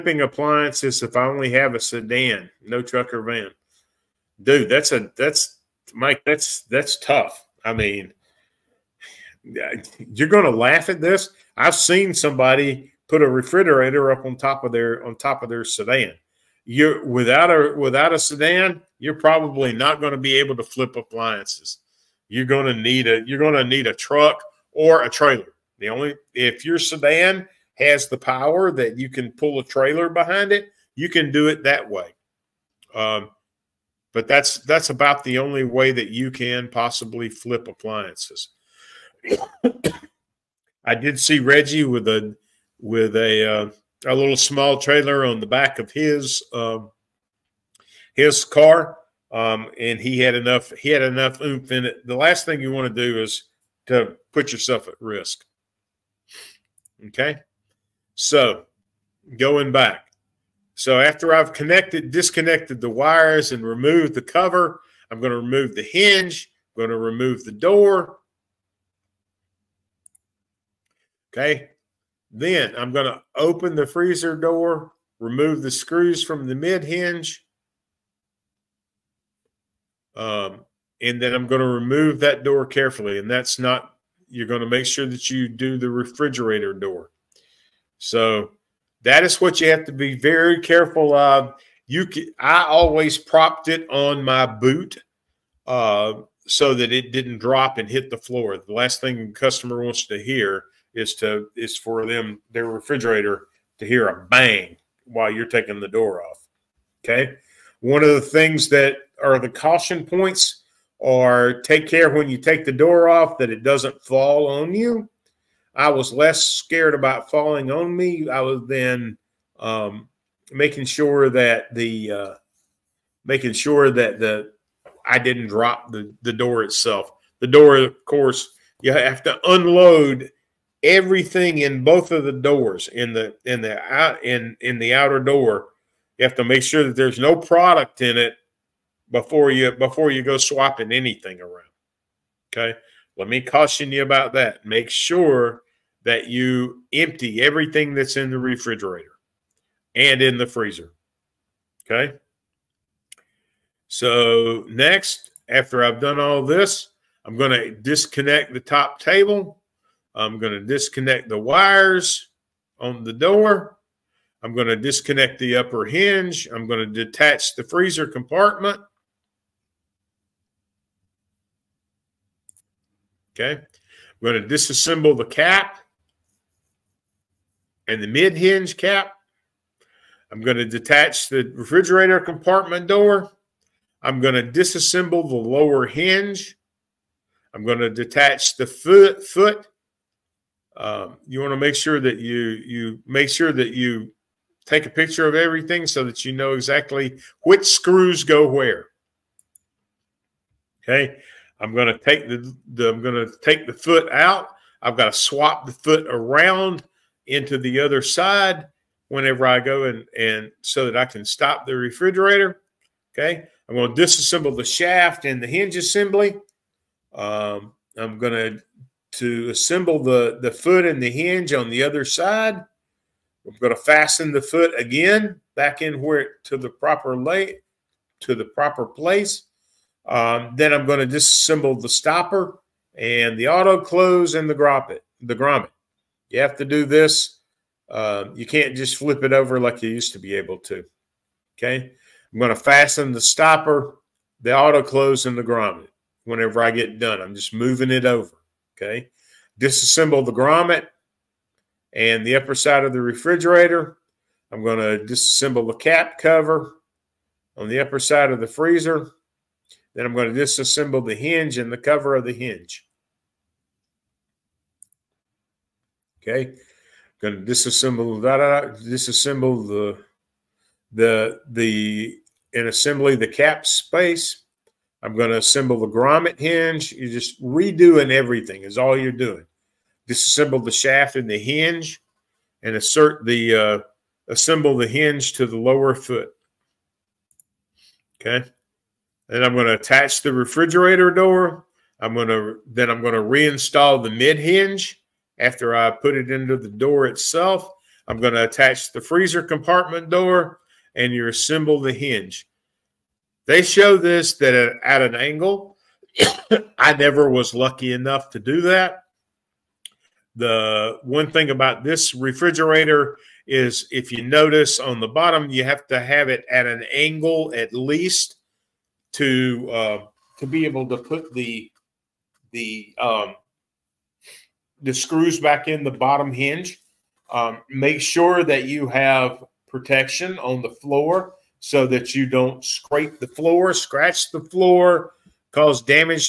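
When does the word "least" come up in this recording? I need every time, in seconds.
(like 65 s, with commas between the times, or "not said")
317 s.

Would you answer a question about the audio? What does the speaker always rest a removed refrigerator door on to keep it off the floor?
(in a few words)
boot.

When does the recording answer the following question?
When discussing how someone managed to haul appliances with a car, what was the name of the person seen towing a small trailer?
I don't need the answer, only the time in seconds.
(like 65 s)
41 s.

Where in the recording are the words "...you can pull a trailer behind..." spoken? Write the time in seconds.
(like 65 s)
28 s.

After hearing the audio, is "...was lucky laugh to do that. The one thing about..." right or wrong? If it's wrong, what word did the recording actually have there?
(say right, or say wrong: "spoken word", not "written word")
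wrong: "enough", not "laugh".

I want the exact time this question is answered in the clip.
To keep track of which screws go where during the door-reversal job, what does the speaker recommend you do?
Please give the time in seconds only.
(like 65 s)
194 s.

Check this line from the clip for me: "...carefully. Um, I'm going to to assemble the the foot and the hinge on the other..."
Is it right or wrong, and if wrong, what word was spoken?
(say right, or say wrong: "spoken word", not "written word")
wrong: "assembly", not "carefully".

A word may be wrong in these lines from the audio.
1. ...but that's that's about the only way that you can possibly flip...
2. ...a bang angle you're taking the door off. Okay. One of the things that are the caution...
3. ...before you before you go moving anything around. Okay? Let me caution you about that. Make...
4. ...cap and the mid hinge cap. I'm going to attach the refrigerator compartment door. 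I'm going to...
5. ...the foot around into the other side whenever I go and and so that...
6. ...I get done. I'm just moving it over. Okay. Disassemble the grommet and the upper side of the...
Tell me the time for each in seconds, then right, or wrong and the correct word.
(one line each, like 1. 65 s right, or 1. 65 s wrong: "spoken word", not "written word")
1. 34 s right
2. 104 s wrong: "while", not "angle"
3. 139 s wrong: "swapping", not "moving"
4. 175 s wrong: "detach", not "attach"
5. 205 s right
6. 246 s right.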